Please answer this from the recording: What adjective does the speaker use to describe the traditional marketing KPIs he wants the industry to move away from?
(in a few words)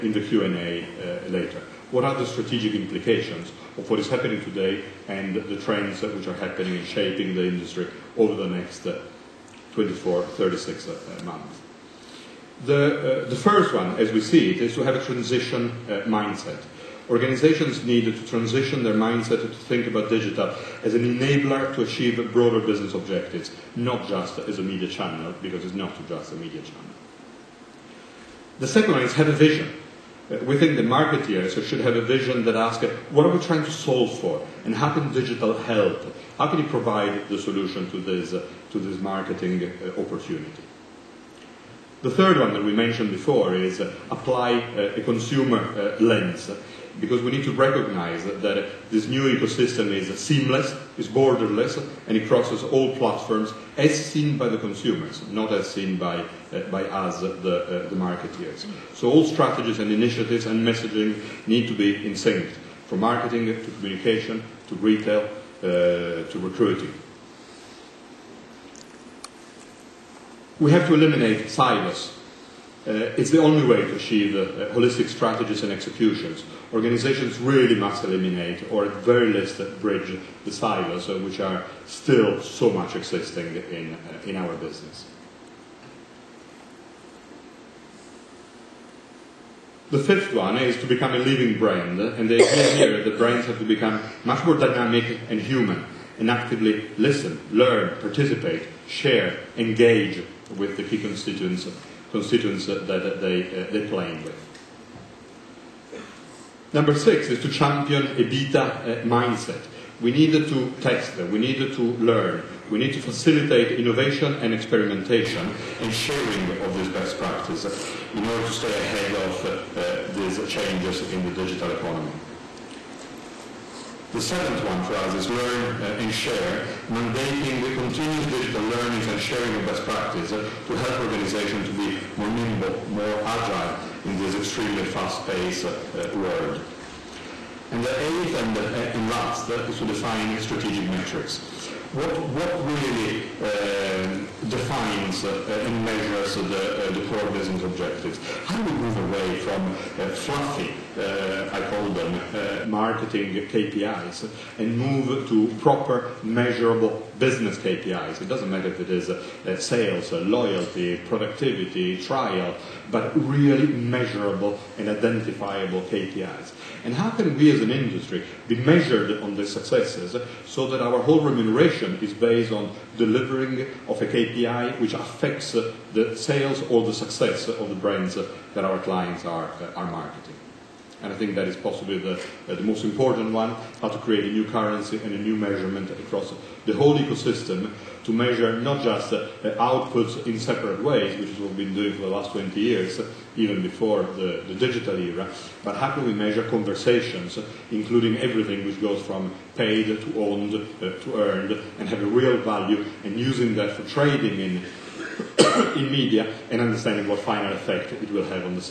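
fluffy.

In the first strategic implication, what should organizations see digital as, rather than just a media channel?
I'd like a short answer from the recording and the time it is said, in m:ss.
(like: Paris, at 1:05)
an enabler, at 0:21.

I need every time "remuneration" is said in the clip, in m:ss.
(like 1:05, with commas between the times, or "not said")
2:51.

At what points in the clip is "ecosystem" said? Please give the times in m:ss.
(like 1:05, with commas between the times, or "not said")
0:49, 3:06.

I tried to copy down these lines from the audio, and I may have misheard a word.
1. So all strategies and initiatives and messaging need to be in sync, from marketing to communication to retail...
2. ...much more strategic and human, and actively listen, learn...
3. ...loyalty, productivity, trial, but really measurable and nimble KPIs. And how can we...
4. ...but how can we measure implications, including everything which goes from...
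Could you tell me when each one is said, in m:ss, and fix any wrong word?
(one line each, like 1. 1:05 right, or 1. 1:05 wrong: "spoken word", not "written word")
1. 0:58 right
2. 1:34 wrong: "dynamic", not "strategic"
3. 2:40 wrong: "identifiable", not "nimble"
4. 3:15 wrong: "conversations", not "implications".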